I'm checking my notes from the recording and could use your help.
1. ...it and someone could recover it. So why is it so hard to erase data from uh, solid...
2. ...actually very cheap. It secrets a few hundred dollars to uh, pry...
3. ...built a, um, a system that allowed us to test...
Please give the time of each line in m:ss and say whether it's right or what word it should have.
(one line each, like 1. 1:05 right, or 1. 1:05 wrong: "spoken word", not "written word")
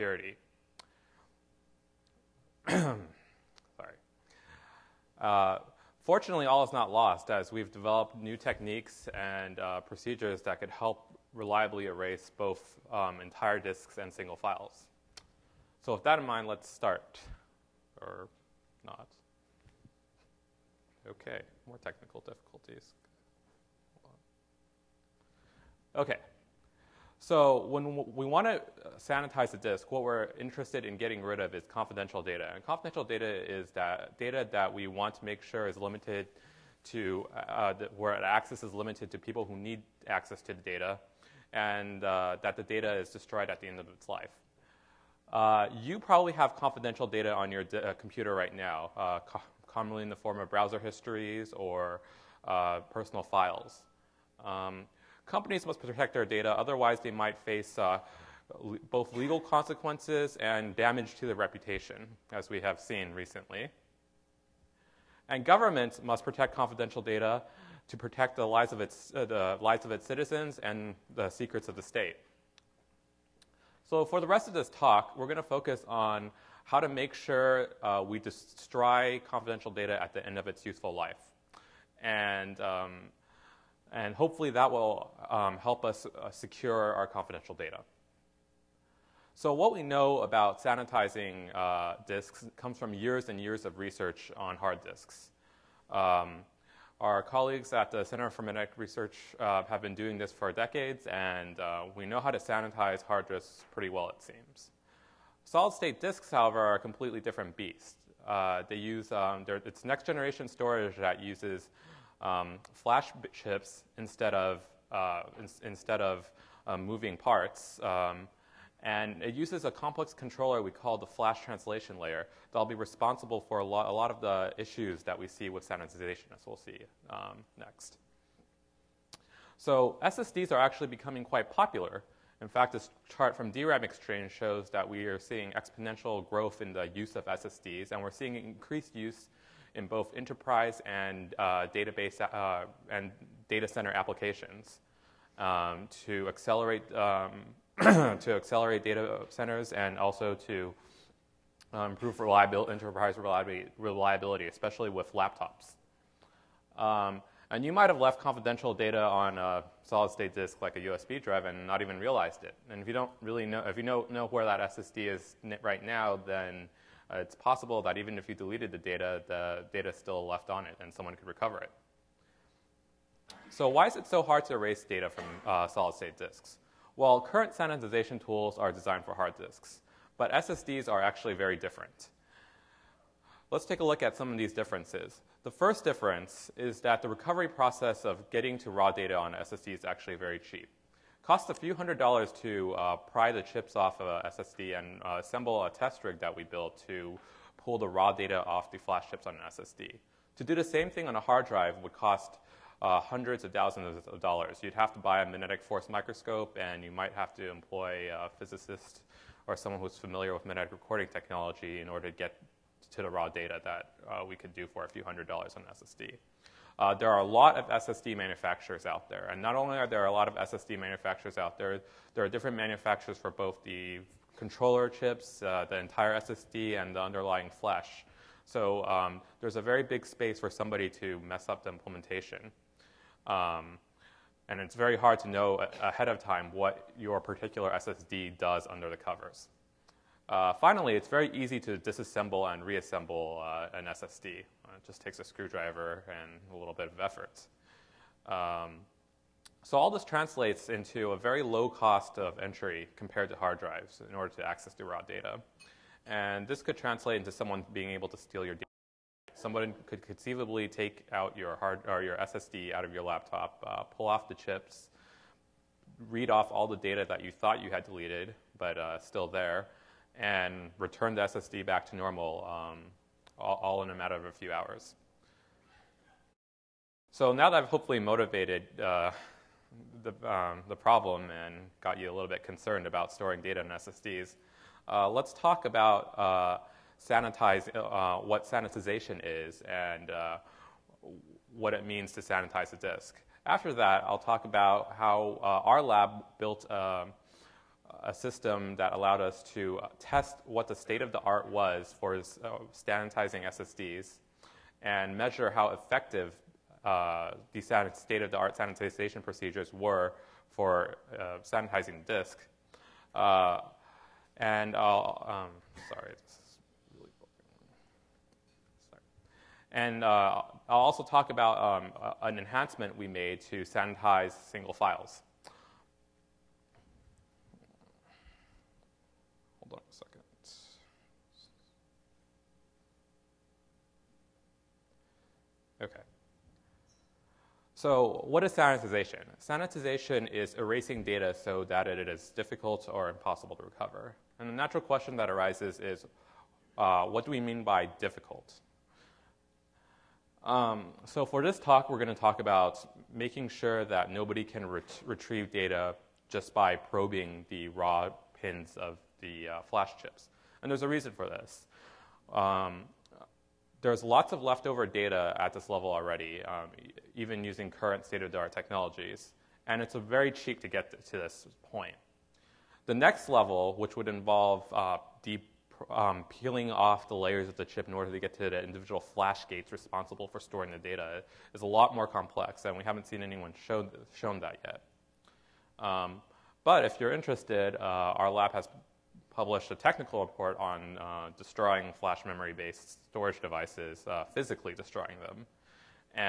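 1. 2:50 right
2. 3:09 wrong: "costs", not "secrets"
3. 4:56 right.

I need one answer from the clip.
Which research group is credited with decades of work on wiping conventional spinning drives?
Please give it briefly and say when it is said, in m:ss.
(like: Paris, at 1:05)
Center for Magnetic Research, at 1:38.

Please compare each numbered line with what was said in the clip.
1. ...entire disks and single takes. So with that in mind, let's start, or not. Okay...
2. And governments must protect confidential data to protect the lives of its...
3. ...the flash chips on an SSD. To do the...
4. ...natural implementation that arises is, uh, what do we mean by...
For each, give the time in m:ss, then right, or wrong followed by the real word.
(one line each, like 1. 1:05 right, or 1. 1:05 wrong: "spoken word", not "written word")
1. 0:13 wrong: "files", not "takes"
2. 1:05 right
3. 3:18 right
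4. 5:44 wrong: "question", not "implementation".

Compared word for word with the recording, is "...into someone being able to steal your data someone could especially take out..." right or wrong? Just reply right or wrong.
wrong.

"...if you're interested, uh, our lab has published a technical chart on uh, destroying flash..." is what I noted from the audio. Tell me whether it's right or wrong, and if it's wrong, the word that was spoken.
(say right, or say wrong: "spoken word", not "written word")
wrong: "report", not "chart".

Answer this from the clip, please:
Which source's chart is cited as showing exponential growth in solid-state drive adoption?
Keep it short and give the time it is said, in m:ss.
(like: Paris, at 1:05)
DRAMeXchange, at 2:13.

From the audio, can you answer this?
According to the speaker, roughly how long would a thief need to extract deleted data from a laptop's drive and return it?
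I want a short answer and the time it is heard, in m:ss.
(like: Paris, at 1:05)
a few hours, at 4:34.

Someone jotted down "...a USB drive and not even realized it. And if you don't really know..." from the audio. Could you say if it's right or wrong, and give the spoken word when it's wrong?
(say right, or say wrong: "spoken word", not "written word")
right.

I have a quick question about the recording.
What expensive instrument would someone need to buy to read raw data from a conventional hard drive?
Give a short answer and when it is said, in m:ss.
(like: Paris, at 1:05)
magnetic force microscope, at 3:25.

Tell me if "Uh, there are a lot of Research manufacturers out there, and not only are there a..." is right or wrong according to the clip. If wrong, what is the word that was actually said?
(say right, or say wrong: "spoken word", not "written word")
wrong: "SSD", not "Research".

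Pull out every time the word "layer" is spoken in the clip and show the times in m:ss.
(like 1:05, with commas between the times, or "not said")
2:01, 6:17.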